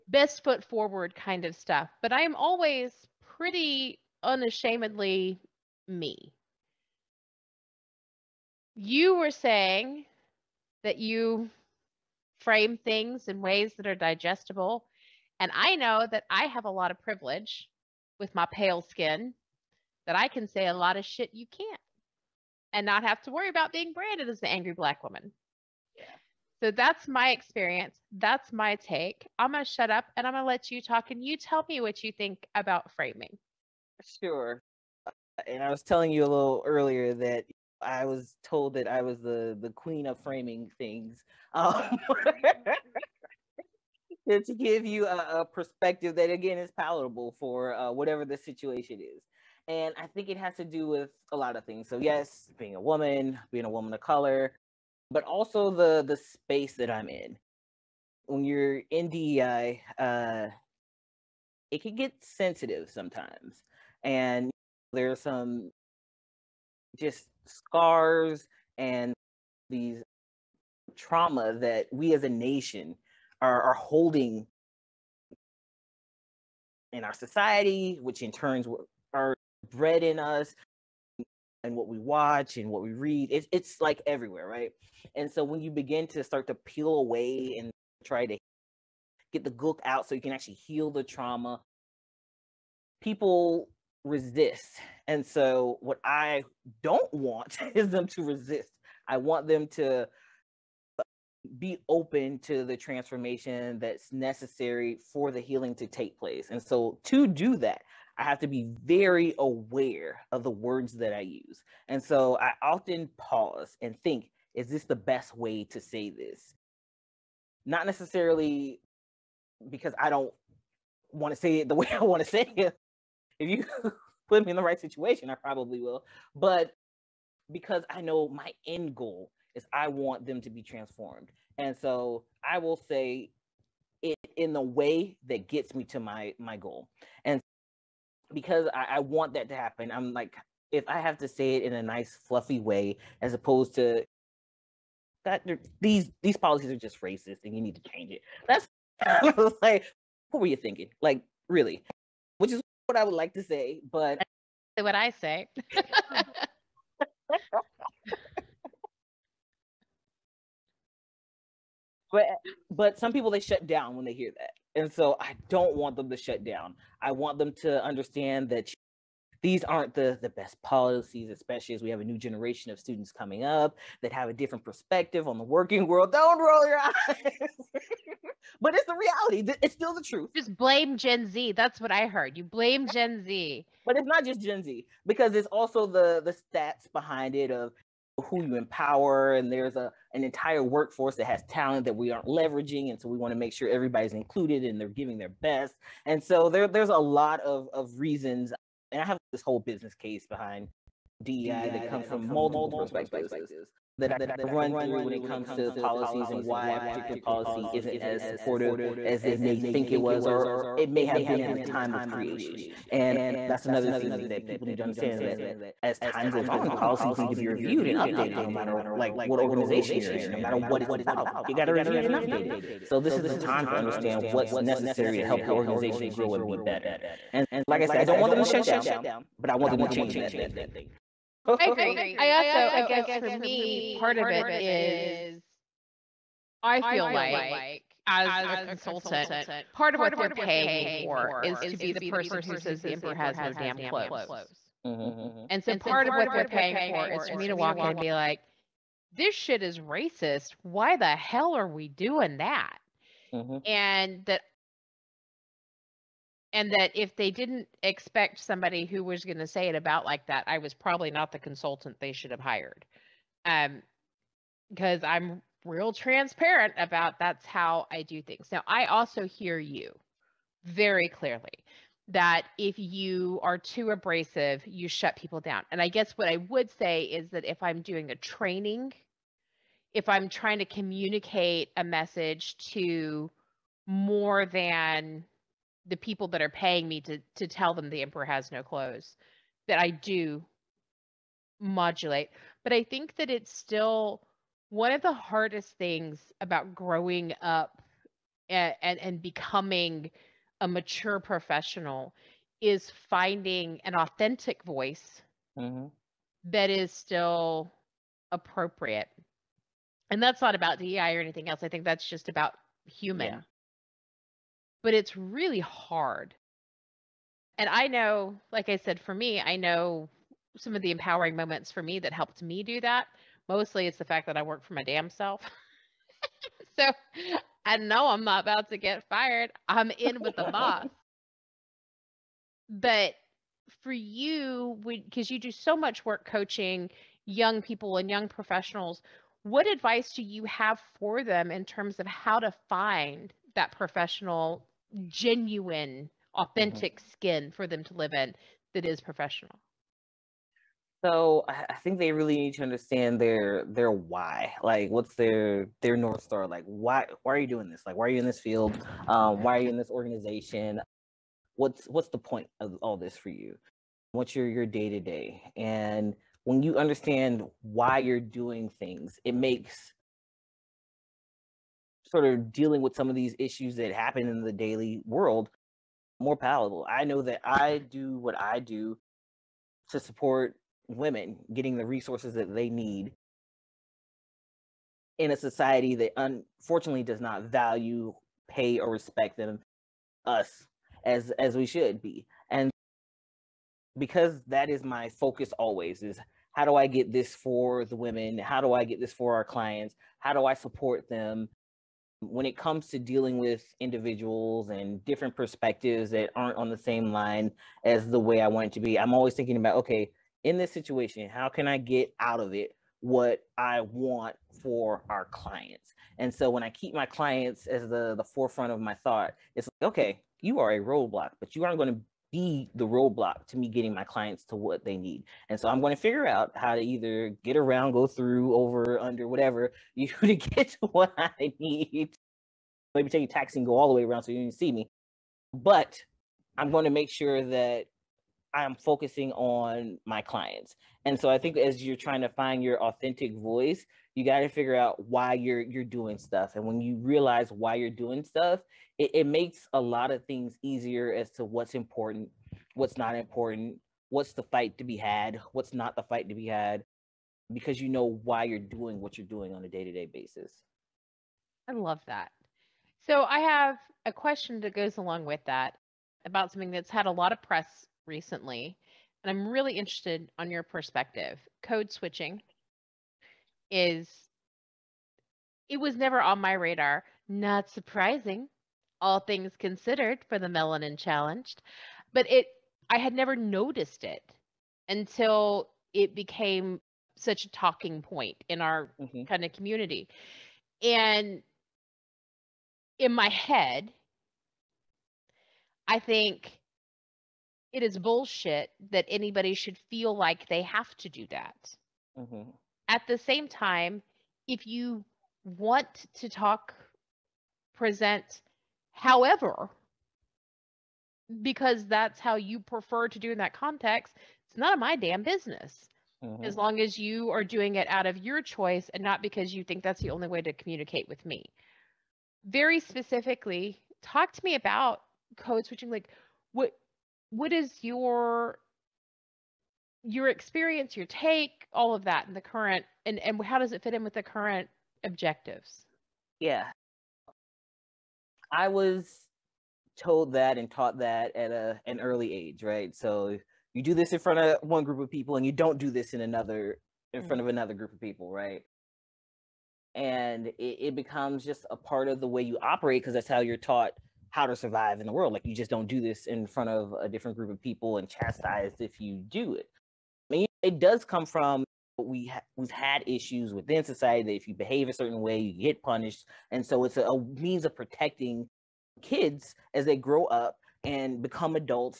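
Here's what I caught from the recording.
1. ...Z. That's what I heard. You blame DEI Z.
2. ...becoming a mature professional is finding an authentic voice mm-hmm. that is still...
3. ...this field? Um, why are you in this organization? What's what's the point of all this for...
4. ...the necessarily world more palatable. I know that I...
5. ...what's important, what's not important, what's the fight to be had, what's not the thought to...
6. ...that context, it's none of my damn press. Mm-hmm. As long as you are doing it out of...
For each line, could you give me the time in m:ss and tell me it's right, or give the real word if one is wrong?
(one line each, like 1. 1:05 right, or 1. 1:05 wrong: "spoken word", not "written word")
1. 3:01 wrong: "Gen", not "DEI"
2. 4:59 right
3. 5:58 right
4. 6:14 wrong: "daily", not "necessarily"
5. 7:31 wrong: "fight", not "thought"
6. 8:33 wrong: "business", not "press".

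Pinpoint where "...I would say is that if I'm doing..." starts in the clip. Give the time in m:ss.
4:36.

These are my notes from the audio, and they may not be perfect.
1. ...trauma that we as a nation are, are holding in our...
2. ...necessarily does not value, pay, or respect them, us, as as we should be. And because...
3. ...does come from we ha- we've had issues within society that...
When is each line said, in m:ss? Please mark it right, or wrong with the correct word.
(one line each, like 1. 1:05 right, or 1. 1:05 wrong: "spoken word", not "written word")
1. 1:10 right
2. 6:26 wrong: "unfortunately", not "necessarily"
3. 9:20 right.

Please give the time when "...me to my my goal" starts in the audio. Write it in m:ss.
2:15.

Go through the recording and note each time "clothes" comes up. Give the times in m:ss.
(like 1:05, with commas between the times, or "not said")
4:03, 4:48.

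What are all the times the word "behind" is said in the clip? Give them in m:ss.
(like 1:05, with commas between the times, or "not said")
3:06, 3:20.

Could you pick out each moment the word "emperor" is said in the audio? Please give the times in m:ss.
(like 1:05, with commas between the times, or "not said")
4:02, 4:48.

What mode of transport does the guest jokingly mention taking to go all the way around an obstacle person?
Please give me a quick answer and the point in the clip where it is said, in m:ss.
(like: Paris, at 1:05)
taxi, at 7:13.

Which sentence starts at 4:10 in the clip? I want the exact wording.
Why the hell are we doing that?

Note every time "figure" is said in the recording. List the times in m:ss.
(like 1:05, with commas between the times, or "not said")
7:05, 7:24.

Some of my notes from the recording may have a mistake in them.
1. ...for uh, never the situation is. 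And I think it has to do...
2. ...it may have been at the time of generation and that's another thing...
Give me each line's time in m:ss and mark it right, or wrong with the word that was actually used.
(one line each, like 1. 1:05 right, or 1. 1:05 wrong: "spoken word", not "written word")
1. 0:47 wrong: "whatever", not "never"
2. 3:30 wrong: "creation", not "generation".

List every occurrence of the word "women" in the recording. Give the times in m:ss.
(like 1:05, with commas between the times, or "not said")
6:20, 6:37.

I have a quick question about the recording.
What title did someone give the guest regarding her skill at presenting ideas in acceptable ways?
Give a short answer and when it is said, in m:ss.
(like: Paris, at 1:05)
queen of framing, at 0:39.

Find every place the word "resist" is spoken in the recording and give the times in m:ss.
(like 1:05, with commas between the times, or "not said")
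1:34, 1:38.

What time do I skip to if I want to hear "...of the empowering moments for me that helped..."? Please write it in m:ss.
5:20.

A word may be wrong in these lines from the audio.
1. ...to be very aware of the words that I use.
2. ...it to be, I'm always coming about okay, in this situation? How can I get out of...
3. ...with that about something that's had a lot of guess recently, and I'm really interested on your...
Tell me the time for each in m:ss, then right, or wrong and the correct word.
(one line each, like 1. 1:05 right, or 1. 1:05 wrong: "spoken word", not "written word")
1. 1:48 right
2. 6:48 wrong: "thinking", not "coming"
3. 7:45 wrong: "press", not "guess".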